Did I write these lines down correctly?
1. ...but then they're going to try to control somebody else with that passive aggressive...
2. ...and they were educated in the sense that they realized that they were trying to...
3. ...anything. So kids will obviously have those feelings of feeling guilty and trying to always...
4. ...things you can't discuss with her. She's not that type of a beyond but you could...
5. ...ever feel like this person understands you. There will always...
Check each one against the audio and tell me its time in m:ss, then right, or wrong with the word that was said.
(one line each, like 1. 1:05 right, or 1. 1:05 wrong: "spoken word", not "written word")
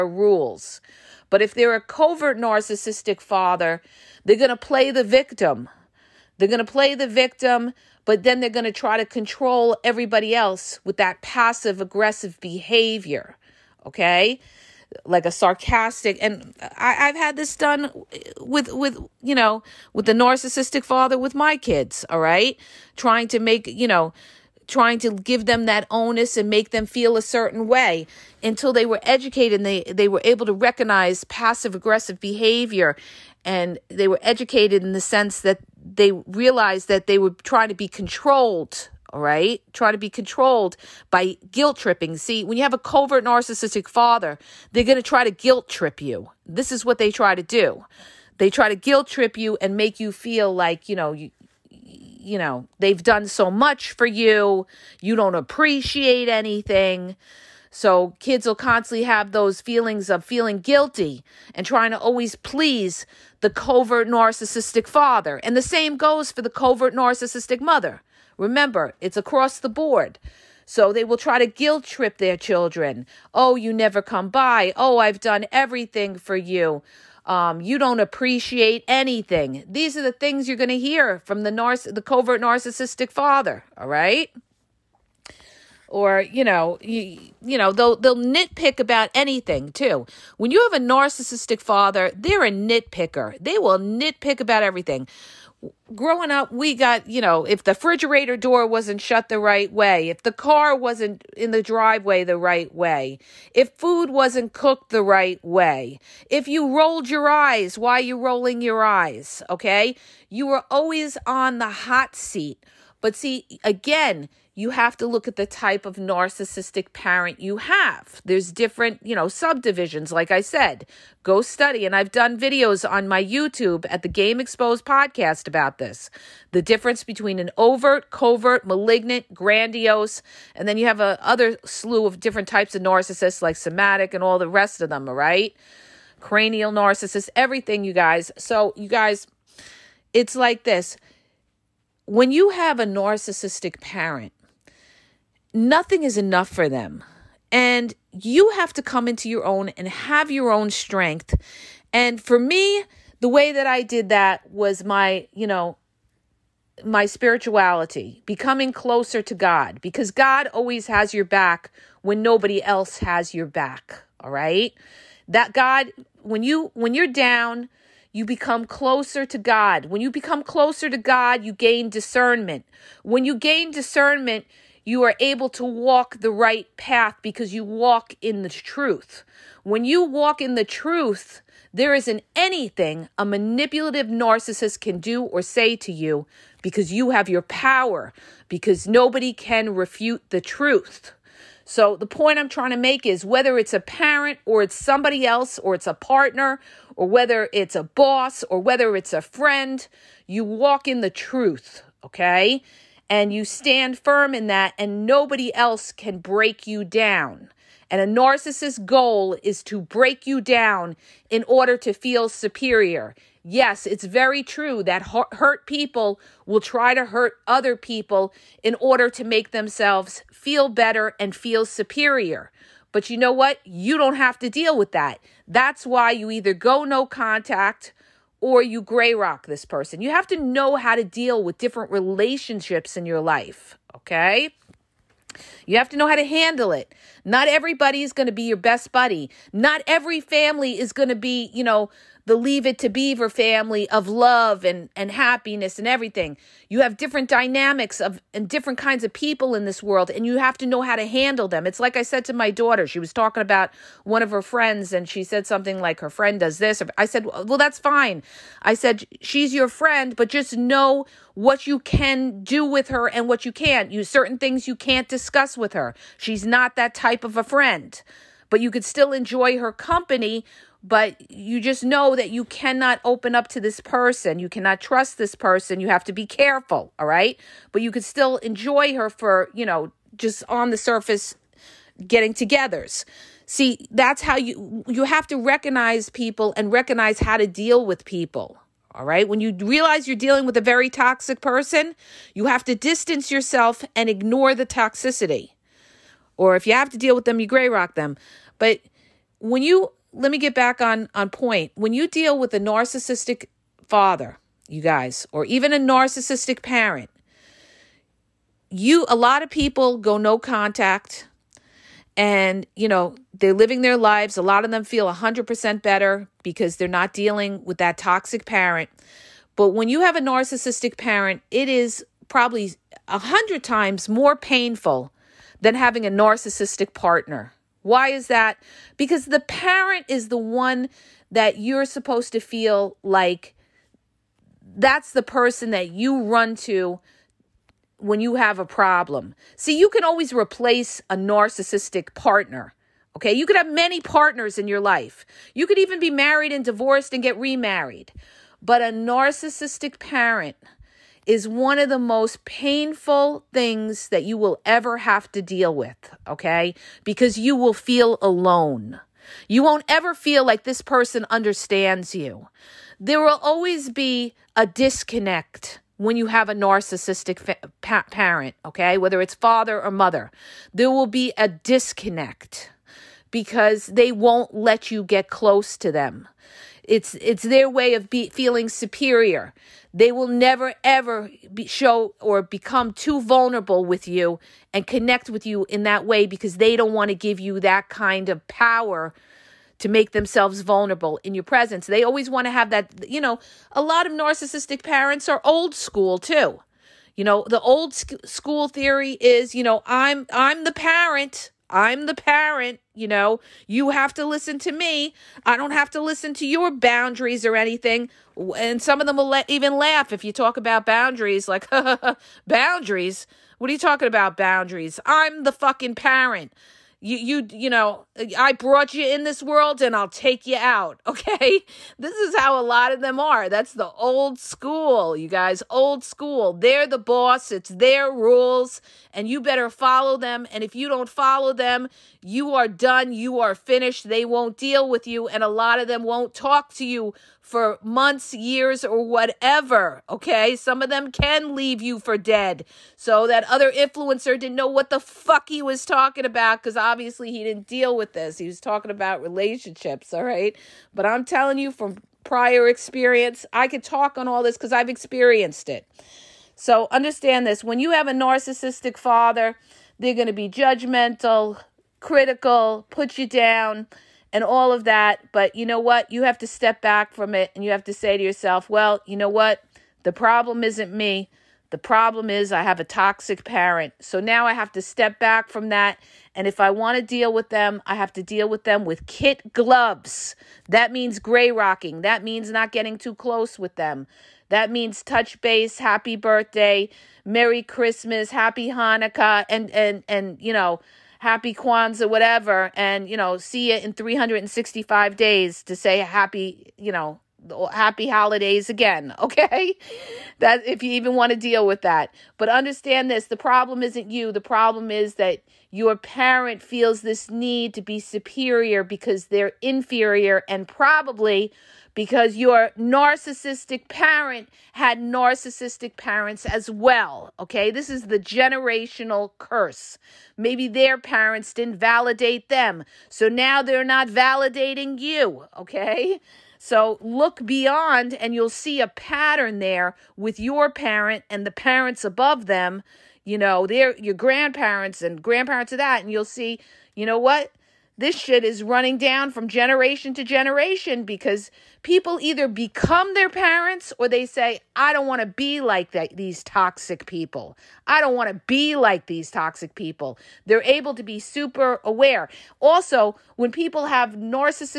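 1. 0:08 wrong: "everybody", not "somebody"
2. 0:33 right
3. 0:56 wrong: "constantly", not "obviously"
4. 4:24 wrong: "friend", not "beyond"
5. 5:59 right.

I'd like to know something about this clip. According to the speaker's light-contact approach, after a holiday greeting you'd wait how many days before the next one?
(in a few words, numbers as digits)
365.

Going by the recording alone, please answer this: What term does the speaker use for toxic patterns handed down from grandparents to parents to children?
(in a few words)
generational curse.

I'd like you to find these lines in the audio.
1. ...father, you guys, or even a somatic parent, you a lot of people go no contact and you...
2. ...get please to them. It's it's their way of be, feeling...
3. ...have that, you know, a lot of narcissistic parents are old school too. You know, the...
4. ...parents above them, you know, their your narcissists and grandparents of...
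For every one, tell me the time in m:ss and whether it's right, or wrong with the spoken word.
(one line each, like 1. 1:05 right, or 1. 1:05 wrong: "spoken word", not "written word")
1. 5:03 wrong: "narcissistic", not "somatic"
2. 6:15 wrong: "close", not "please"
3. 6:32 right
4. 8:51 wrong: "grandparents", not "narcissists".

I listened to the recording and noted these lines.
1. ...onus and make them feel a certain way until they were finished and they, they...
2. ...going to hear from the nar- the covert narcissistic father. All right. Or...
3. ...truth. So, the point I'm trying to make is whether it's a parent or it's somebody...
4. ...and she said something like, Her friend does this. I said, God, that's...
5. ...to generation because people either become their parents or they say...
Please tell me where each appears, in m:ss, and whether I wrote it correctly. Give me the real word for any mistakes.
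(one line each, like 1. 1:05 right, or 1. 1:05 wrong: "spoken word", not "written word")
1. 0:25 wrong: "educated", not "finished"
2. 1:20 right
3. 3:10 right
4. 4:14 wrong: "Well", not "God"
5. 9:00 right.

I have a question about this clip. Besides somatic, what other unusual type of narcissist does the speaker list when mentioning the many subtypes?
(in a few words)
Cranial.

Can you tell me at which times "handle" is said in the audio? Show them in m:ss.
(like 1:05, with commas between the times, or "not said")
3:56, 4:11.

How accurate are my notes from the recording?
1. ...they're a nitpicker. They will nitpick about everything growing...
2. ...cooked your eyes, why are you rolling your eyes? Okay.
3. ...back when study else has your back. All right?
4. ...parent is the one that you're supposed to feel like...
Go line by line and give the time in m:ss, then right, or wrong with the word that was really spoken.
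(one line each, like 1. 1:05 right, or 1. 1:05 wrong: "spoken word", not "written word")
1. 1:32 right
2. 1:46 wrong: "rolled", not "cooked"
3. 2:41 wrong: "nobody", not "study"
4. 5:29 right.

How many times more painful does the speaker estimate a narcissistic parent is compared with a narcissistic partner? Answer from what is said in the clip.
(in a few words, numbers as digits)
100.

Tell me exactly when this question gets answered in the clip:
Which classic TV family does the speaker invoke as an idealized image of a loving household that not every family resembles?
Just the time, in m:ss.
4:02.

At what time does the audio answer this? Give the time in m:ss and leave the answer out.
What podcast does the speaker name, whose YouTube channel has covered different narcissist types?
2:04.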